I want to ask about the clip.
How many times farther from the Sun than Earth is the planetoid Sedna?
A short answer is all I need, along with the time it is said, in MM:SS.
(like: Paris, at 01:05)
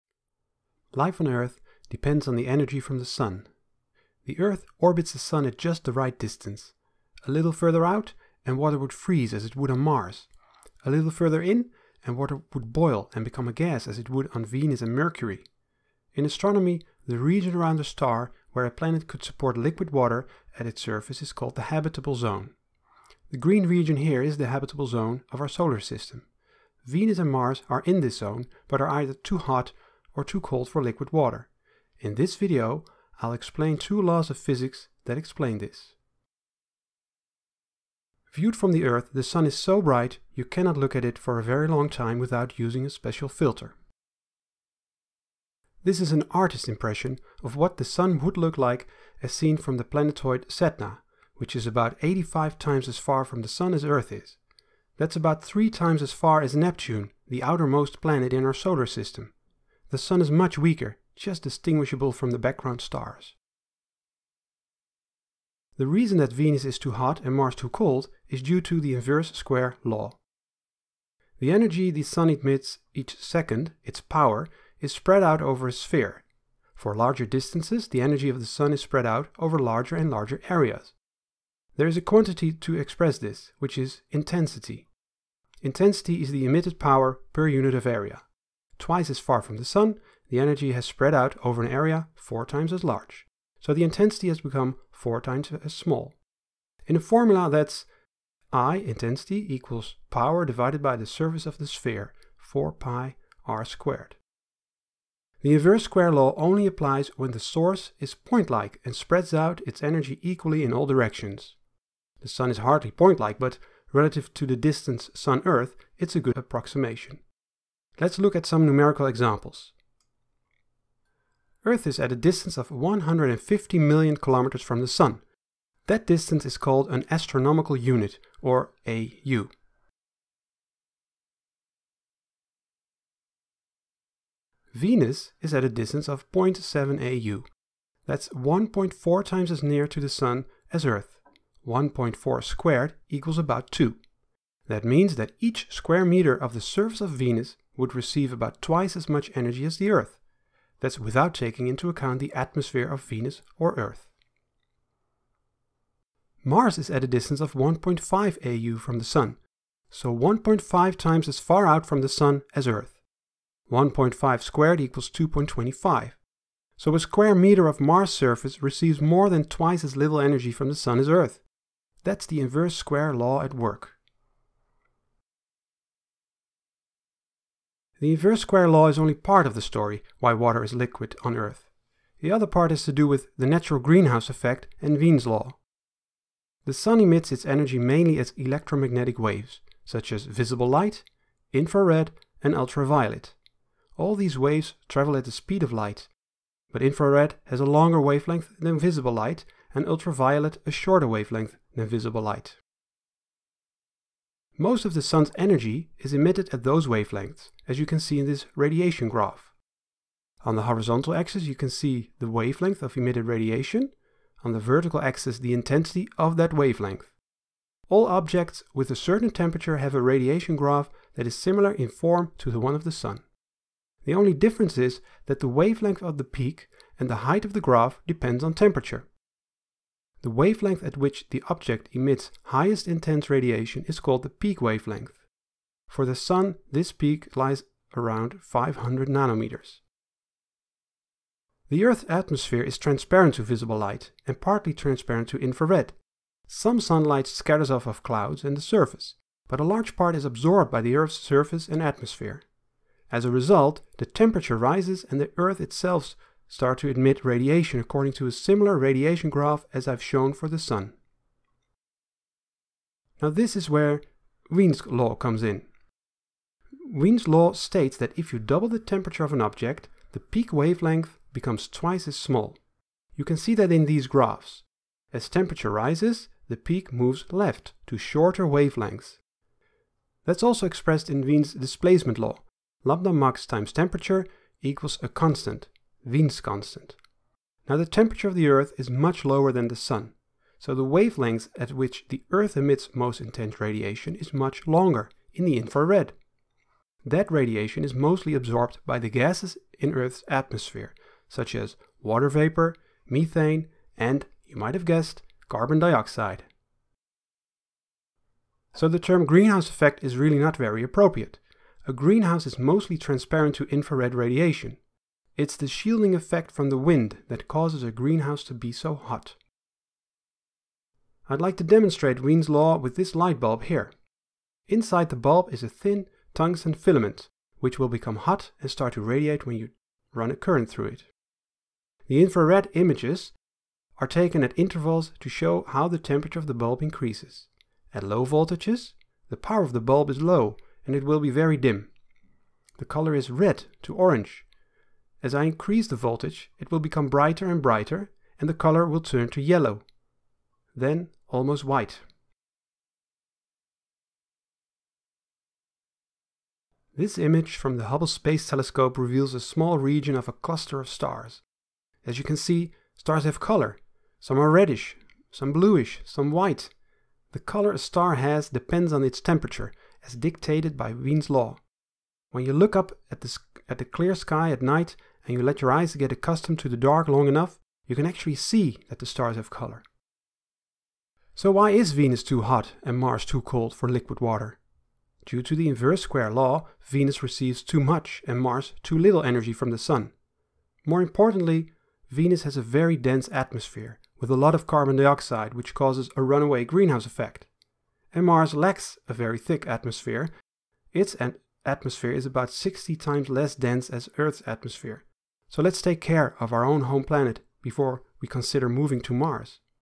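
85, at 00:52.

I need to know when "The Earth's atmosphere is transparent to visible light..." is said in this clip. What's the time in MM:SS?
04:01.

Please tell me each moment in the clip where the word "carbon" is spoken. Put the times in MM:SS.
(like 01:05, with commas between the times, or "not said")
05:05, 06:34.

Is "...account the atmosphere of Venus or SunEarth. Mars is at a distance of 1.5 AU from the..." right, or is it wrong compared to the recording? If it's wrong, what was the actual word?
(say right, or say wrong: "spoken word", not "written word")
wrong: "Earth", not "SunEarth".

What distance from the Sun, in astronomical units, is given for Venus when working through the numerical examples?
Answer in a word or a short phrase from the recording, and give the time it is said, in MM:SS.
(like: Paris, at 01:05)
0.7 AU, at 02:16.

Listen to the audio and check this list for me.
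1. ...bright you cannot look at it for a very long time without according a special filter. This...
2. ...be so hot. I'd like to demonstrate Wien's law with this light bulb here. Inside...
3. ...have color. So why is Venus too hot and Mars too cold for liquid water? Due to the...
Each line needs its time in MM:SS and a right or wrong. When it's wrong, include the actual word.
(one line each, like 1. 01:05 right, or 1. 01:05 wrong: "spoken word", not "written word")
1. 00:39 wrong: "using", not "according"
2. 05:18 right
3. 06:19 right.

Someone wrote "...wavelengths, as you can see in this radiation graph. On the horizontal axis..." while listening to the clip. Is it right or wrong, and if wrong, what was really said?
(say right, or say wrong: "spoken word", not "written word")
right.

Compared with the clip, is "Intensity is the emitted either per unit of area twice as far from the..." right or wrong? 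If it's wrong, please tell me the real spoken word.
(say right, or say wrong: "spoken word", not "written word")
wrong: "power", not "either".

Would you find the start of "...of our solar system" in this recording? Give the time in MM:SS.
00:25.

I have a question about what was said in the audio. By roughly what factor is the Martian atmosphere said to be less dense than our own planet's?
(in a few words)
60.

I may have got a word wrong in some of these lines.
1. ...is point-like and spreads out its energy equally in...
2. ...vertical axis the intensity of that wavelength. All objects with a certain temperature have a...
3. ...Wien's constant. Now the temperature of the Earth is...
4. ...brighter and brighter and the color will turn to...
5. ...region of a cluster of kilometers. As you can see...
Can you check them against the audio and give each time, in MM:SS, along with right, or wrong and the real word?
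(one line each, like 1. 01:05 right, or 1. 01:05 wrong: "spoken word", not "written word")
1. 01:48 right
2. 03:34 right
3. 04:46 right
4. 05:47 right
5. 05:59 wrong: "stars", not "kilometers".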